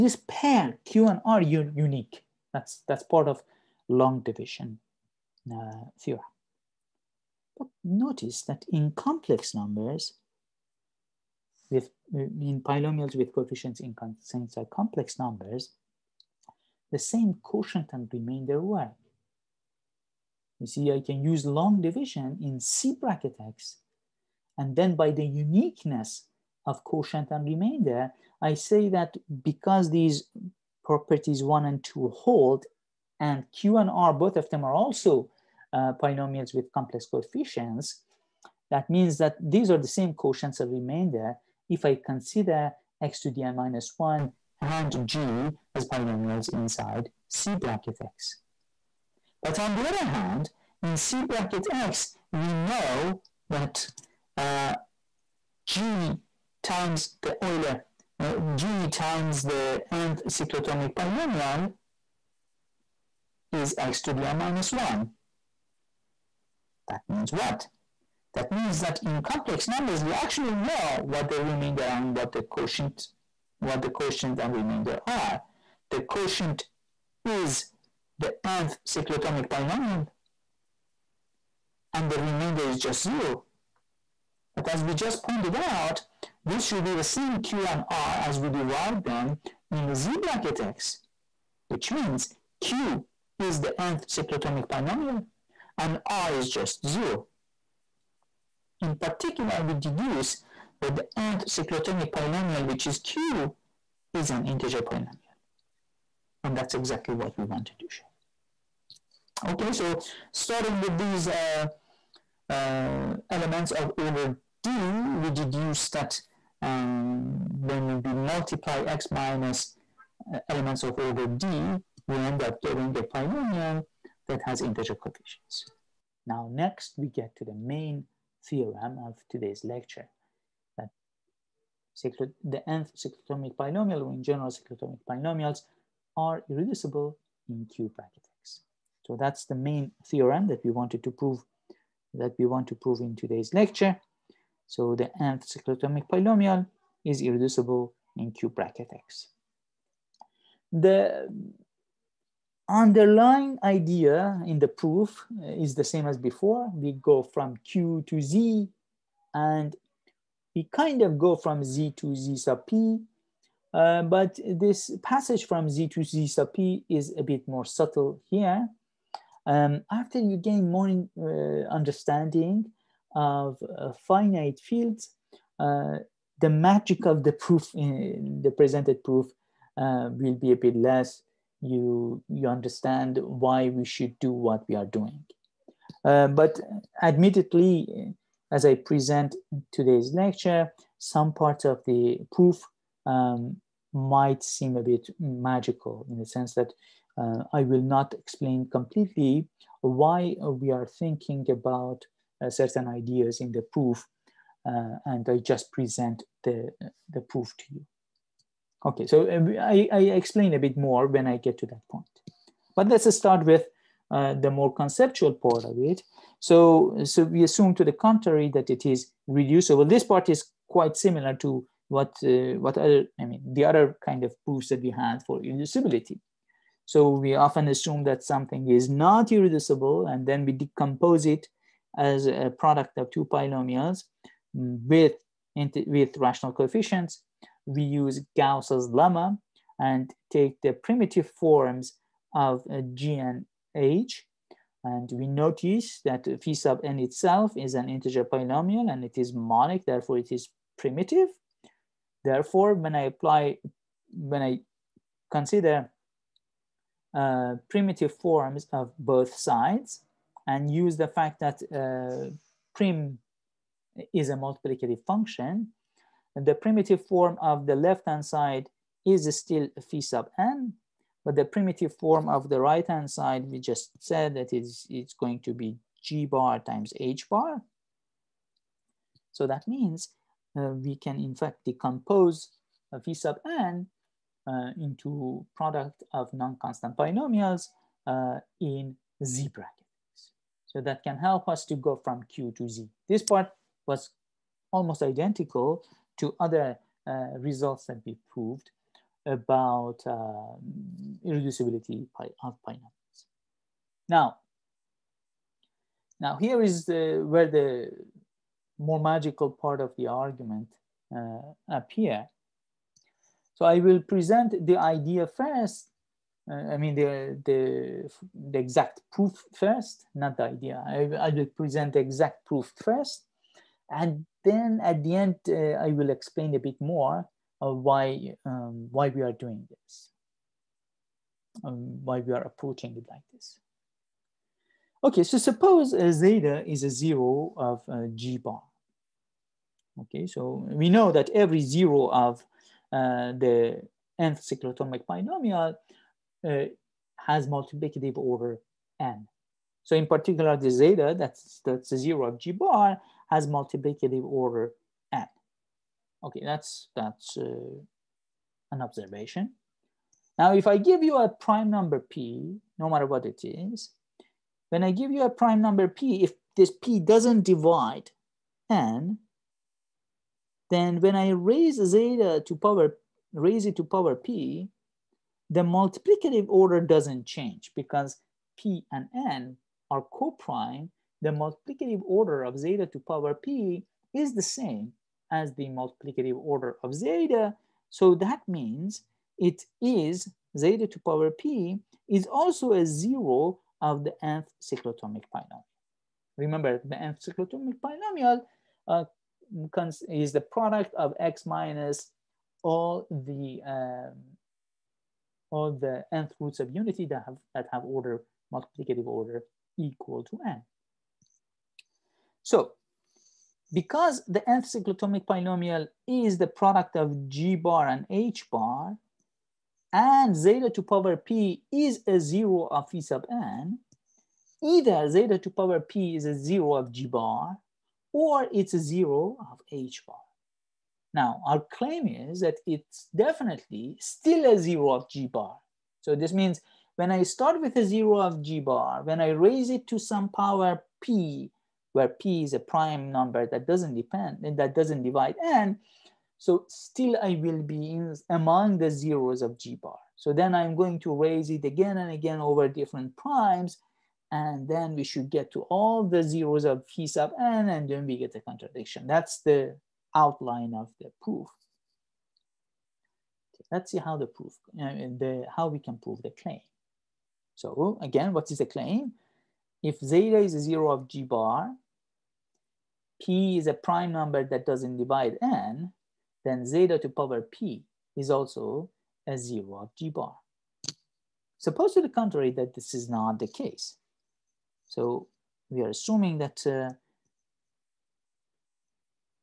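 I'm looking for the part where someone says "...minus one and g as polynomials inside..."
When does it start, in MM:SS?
00:43.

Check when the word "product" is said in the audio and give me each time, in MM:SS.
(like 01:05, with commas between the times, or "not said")
03:52, 04:45, 06:40, 06:56.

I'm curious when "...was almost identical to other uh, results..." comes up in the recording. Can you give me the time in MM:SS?
04:53.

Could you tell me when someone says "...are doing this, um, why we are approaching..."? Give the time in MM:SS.
05:29.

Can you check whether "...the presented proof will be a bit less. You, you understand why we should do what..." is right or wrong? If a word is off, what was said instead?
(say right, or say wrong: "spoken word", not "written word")
right.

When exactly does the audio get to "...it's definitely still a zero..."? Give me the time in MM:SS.
07:12.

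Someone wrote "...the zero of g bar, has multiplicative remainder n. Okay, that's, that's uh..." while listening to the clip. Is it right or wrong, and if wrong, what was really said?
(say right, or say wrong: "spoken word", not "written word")
wrong: "order", not "remainder".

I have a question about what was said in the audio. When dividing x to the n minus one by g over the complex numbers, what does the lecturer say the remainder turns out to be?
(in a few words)
0.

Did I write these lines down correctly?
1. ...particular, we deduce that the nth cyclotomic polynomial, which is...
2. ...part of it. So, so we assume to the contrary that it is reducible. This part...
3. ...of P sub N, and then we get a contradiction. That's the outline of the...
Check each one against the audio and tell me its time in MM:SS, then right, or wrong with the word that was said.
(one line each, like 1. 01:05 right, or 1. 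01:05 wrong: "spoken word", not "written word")
1. 01:38 right
2. 03:35 right
3. 07:36 right.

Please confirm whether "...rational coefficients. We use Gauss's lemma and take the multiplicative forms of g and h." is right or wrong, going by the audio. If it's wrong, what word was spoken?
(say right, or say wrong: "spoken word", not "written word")
wrong: "primitive", not "multiplicative".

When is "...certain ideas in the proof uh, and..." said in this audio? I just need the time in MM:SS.
03:22.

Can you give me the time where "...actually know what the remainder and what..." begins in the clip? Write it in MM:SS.
01:10.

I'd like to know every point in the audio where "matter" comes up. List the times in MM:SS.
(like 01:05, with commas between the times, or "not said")
06:02.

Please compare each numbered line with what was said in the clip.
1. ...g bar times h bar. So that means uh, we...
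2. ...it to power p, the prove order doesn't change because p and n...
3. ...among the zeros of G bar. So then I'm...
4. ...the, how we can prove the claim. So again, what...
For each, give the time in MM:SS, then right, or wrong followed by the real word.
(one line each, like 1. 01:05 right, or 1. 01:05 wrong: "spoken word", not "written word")
1. 04:36 right
2. 06:13 wrong: "multiplicative", not "prove"
3. 07:28 right
4. 07:44 right.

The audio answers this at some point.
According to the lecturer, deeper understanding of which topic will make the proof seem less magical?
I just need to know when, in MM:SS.
02:54.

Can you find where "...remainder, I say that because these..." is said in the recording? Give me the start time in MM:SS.
00:27.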